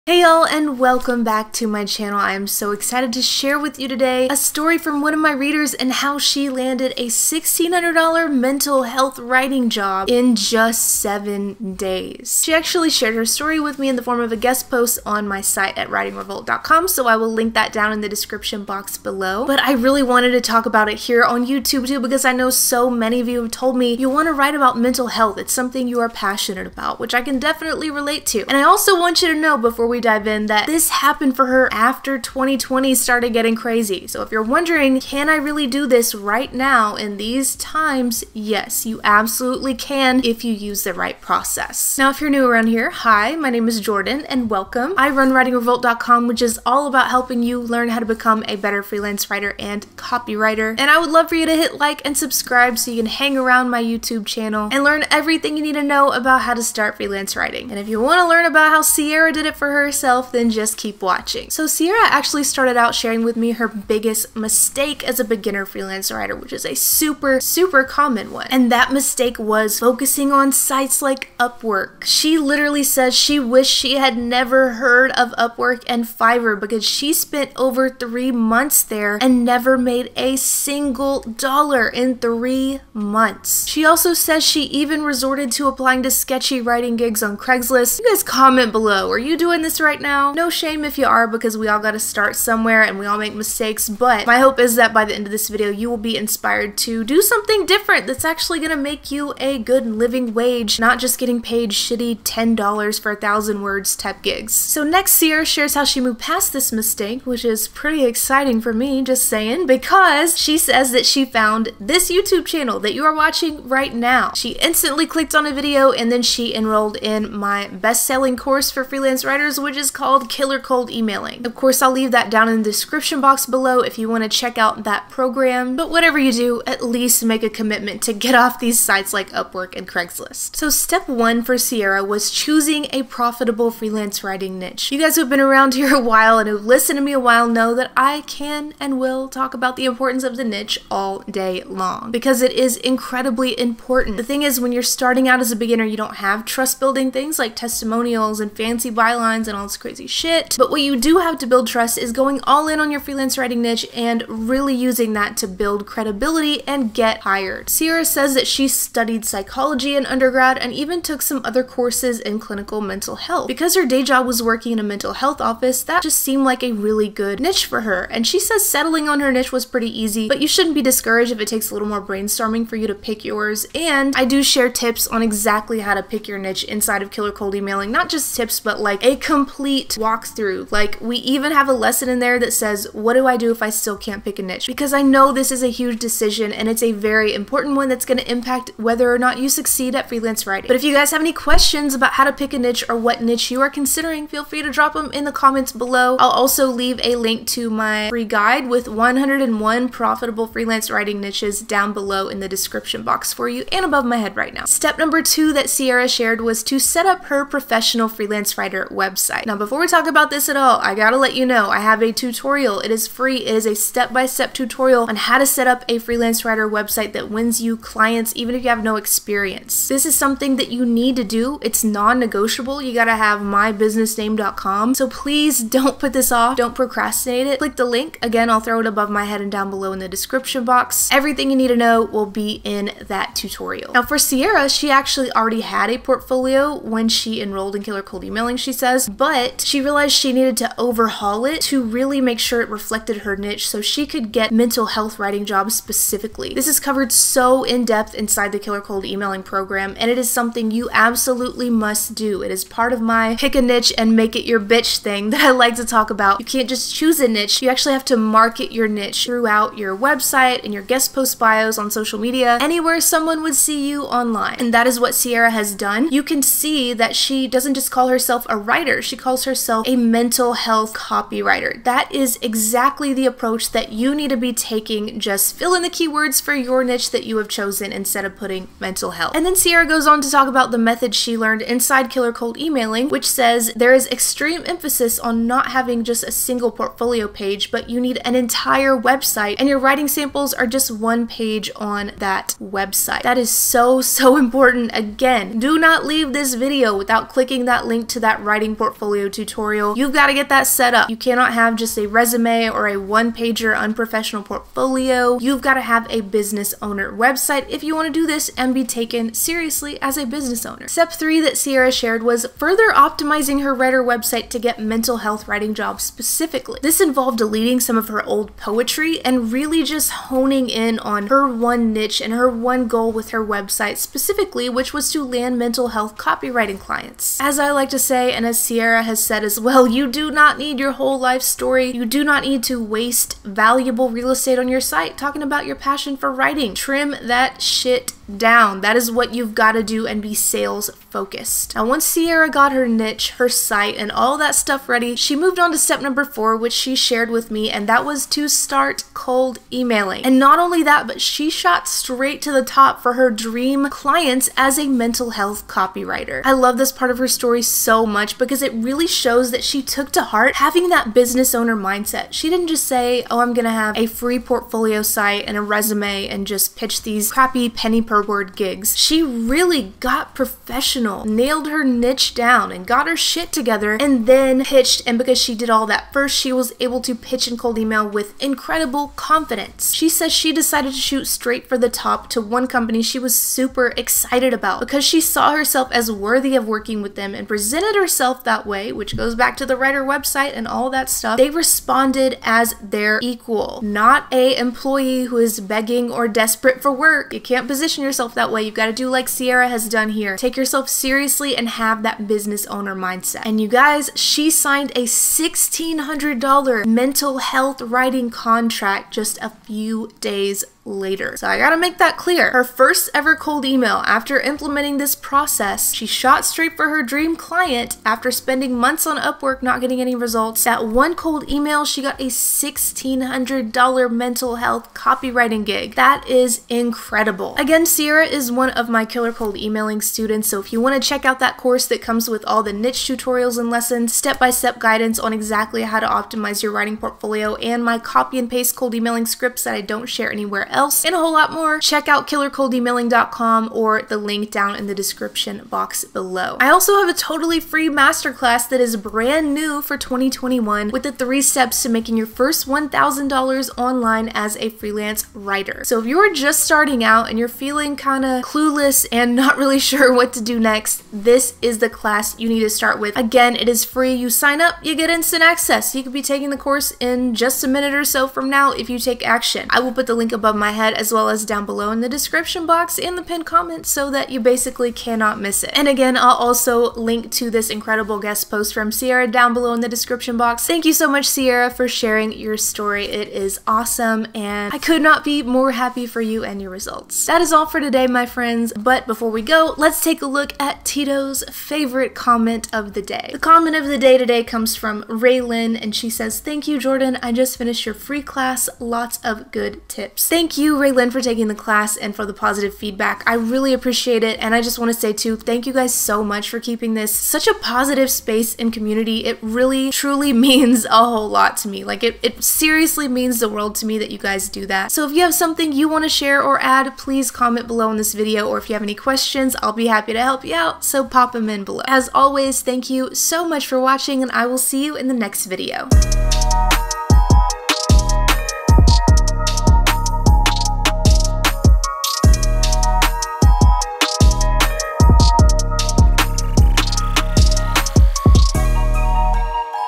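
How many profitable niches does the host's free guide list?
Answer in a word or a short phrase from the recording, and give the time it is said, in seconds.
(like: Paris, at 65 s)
101, at 198 s.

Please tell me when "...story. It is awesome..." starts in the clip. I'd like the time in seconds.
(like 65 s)
482 s.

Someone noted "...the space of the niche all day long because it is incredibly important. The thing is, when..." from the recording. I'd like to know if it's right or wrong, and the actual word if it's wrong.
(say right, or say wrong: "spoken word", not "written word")
wrong: "importance", not "space".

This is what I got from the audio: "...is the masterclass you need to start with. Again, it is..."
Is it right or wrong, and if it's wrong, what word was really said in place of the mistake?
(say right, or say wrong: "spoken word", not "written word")
wrong: "class", not "masterclass".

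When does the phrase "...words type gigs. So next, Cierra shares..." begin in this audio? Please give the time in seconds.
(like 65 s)
103 s.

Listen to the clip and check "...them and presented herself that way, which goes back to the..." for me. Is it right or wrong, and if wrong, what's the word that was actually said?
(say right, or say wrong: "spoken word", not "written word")
right.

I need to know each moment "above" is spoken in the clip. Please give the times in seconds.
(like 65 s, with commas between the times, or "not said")
203 s, 228 s, 470 s.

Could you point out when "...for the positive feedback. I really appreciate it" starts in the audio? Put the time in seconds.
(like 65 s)
502 s.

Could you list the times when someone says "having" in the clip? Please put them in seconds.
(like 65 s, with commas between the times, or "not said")
285 s, 360 s.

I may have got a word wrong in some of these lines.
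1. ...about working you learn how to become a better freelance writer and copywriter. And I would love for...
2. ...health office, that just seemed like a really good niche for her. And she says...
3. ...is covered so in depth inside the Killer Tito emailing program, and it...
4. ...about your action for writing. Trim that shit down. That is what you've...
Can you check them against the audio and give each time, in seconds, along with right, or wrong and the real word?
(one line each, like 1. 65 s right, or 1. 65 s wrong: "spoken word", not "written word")
1. 46 s wrong: "helping", not "working"
2. 165 s right
3. 246 s wrong: "Cold", not "Tito"
4. 335 s wrong: "passion", not "action".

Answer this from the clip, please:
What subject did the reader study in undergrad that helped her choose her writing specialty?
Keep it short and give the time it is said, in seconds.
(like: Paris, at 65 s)
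psychology, at 159 s.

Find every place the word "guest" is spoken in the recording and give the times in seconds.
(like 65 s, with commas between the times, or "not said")
14 s, 260 s, 478 s.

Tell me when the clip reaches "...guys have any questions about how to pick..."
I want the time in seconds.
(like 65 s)
190 s.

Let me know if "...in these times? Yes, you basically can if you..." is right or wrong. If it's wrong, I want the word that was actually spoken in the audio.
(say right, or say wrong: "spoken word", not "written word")
wrong: "absolutely", not "basically".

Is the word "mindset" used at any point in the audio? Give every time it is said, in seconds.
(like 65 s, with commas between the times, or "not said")
361 s, 402 s.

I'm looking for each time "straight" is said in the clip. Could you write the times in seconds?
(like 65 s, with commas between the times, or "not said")
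351 s, 381 s, 416 s.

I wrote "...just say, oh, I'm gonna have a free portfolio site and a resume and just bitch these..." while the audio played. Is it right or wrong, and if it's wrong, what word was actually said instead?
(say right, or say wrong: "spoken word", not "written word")
wrong: "pitch", not "bitch".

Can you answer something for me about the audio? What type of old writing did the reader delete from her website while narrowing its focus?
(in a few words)
poetry.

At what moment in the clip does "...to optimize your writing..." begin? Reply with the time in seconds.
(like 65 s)
435 s.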